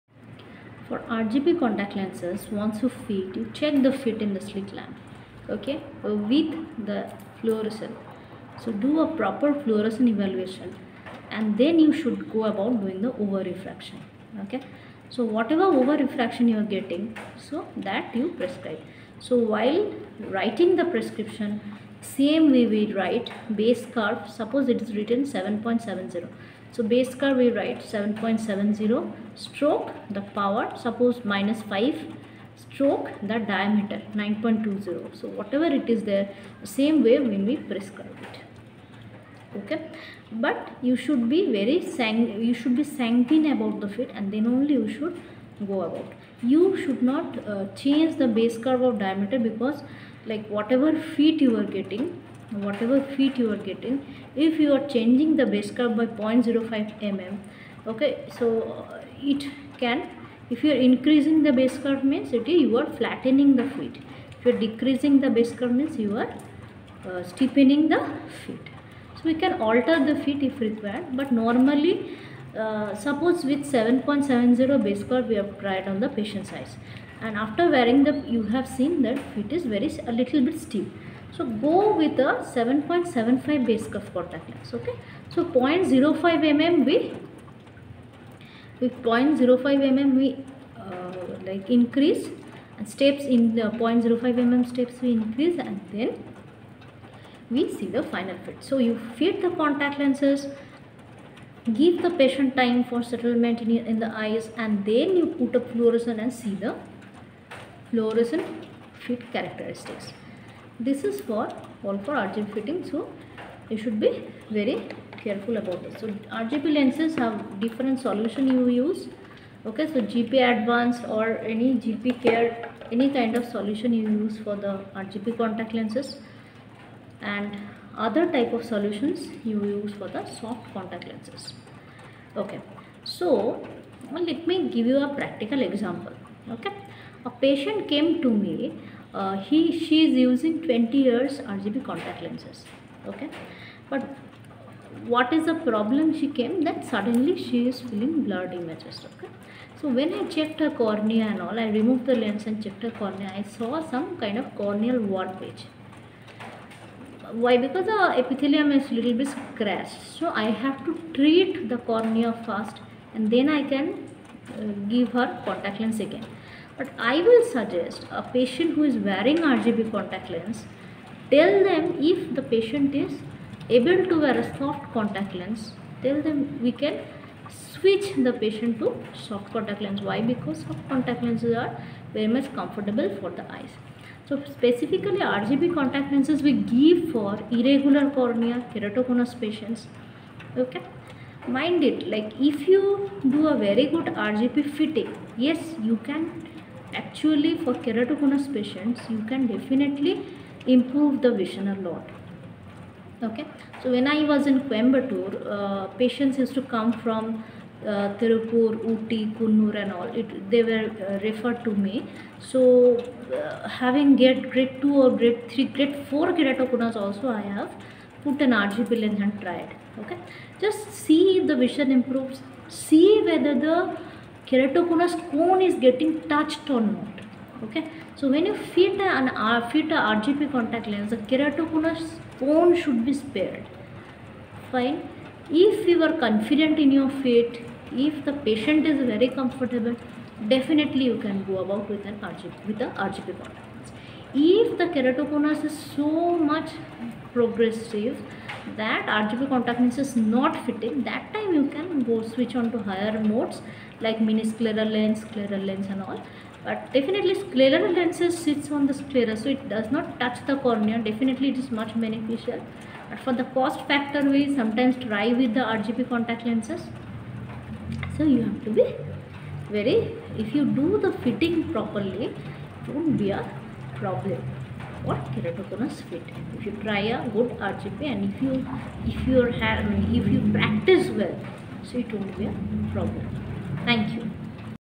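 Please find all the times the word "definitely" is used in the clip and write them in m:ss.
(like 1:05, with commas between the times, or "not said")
3:19, 4:00, 4:16, 4:20.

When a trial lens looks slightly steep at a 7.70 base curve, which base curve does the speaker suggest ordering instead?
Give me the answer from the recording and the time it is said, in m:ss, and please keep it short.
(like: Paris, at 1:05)
7.75, at 1:22.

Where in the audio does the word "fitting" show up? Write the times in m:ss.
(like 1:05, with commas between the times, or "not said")
1:52, 3:14, 4:10, 4:31.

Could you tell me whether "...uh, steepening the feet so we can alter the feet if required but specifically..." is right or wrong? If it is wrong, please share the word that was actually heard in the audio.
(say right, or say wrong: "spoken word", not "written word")
wrong: "normally", not "specifically".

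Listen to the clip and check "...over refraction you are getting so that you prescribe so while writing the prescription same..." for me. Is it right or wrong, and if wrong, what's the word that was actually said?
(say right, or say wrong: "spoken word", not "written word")
right.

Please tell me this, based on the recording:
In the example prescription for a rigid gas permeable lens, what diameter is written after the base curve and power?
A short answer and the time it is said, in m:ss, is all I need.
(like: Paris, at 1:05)
9.20, at 0:34.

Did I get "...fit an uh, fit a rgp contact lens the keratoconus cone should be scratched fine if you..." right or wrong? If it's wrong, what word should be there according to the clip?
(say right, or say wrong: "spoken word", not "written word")
wrong: "spared", not "scratched".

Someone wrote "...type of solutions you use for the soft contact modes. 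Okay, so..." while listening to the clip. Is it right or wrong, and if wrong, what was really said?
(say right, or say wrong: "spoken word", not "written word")
wrong: "lenses", not "modes".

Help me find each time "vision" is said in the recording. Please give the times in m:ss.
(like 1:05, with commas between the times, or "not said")
3:21, 3:41.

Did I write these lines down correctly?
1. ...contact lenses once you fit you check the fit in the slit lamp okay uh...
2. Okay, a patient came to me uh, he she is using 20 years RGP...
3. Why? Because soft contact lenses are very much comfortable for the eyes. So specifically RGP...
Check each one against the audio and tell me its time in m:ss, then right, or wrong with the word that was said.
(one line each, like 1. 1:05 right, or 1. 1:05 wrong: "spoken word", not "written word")
1. 0:01 right
2. 2:16 right
3. 3:00 right.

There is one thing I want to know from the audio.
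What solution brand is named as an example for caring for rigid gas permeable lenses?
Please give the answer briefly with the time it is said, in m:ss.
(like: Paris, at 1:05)
GP Advance, at 2:00.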